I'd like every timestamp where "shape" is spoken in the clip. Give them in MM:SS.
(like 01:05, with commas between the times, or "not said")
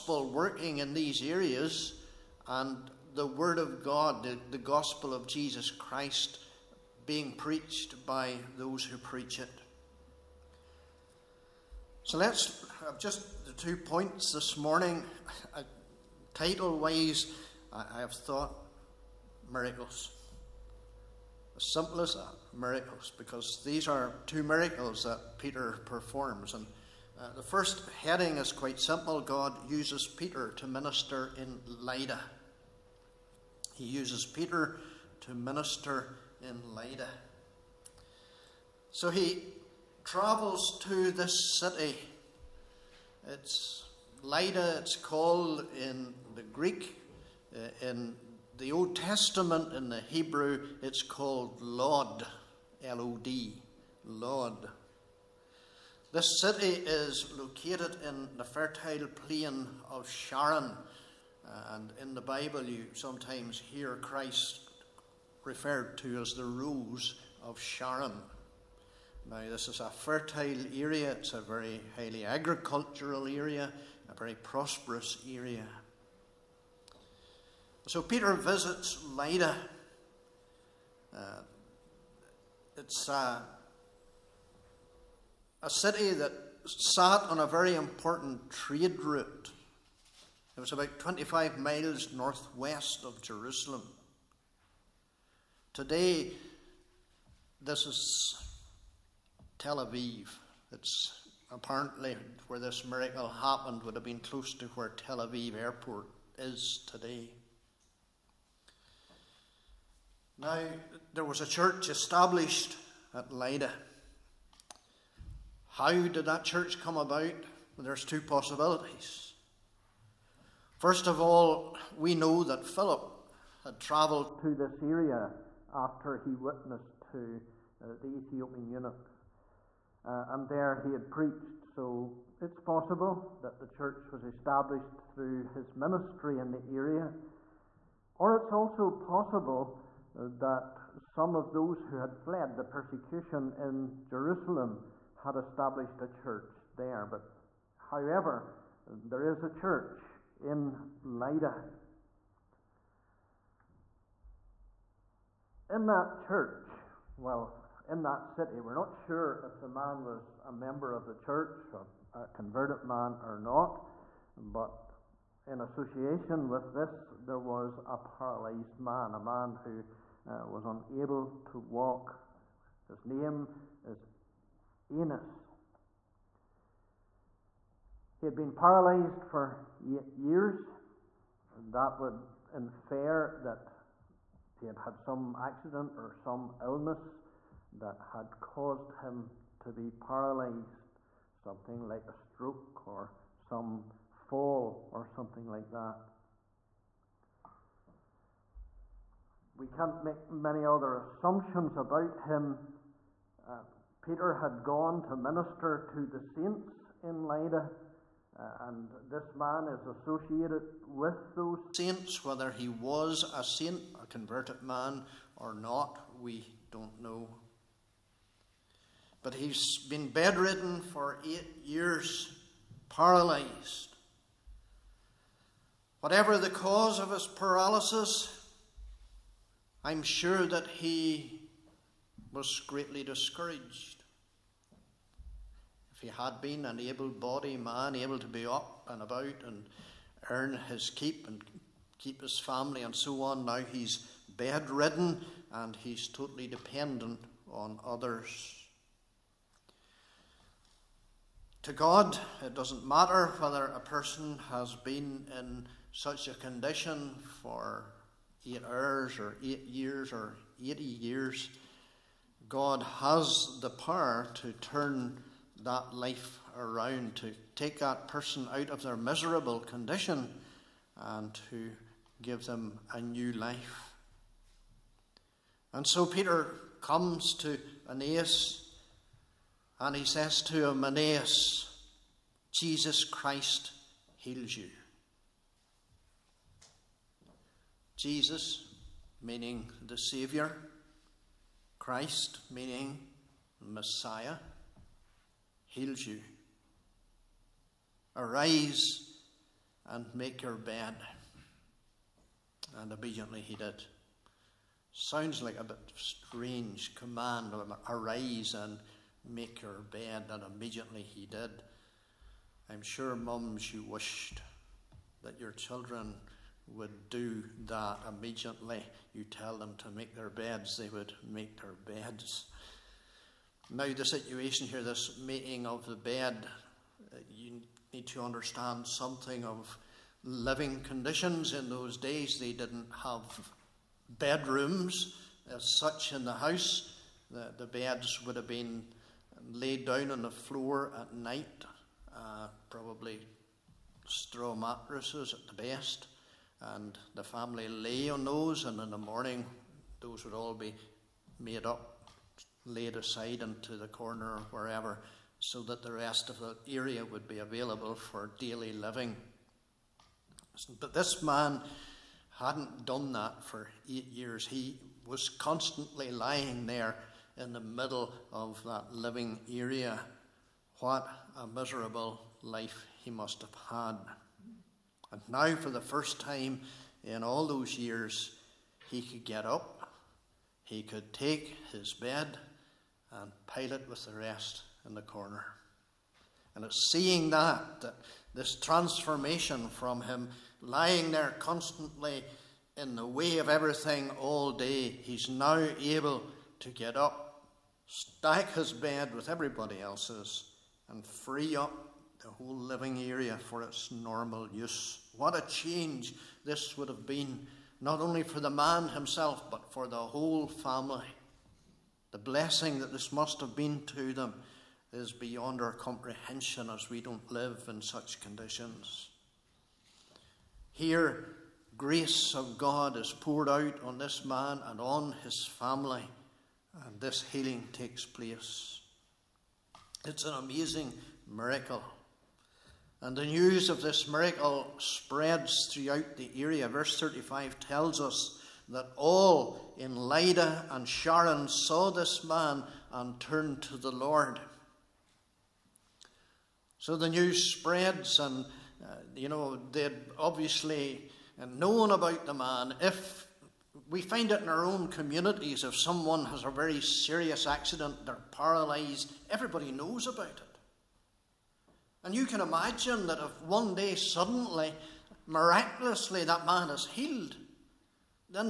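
not said.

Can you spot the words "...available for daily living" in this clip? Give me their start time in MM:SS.
05:57.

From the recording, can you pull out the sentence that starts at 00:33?
He uses Peter to minister in Lydda.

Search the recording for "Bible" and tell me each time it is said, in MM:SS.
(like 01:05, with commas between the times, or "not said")
01:02.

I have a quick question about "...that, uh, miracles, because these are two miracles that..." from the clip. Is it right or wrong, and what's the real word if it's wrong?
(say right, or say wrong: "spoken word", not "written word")
right.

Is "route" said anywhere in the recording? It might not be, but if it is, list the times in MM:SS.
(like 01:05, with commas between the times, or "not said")
01:28.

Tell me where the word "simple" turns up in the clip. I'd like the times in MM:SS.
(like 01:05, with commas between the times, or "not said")
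00:21, 00:28.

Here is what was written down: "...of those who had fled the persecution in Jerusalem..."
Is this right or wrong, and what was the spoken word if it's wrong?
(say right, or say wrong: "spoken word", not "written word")
right.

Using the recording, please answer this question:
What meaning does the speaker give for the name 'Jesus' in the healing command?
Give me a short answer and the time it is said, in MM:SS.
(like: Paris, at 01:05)
Saviour, at 04:49.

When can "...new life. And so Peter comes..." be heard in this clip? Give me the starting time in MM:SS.
04:32.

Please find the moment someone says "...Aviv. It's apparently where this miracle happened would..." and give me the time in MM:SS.
01:39.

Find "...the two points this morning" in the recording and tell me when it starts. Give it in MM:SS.
00:13.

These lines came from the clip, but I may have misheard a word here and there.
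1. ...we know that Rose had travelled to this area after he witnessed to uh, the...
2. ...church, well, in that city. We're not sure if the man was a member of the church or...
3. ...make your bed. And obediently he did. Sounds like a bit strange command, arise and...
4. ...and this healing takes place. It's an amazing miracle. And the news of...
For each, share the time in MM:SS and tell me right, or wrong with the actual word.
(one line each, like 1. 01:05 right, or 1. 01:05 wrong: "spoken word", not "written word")
1. 02:01 wrong: "Philip", not "Rose"
2. 02:36 right
3. 05:00 right
4. 07:06 right.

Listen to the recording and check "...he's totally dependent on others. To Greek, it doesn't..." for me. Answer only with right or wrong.
wrong.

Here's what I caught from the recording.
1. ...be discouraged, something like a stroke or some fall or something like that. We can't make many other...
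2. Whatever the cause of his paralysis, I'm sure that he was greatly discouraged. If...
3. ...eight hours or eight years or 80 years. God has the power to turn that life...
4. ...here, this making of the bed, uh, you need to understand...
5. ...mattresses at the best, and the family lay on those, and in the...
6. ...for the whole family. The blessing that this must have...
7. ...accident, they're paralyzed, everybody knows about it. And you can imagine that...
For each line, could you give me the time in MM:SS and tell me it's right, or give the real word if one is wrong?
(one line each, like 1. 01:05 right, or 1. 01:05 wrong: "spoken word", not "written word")
1. 03:09 wrong: "paralyzed", not "discouraged"
2. 03:45 right
3. 04:18 right
4. 05:24 right
5. 05:44 right
6. 06:49 right
7. 07:37 right.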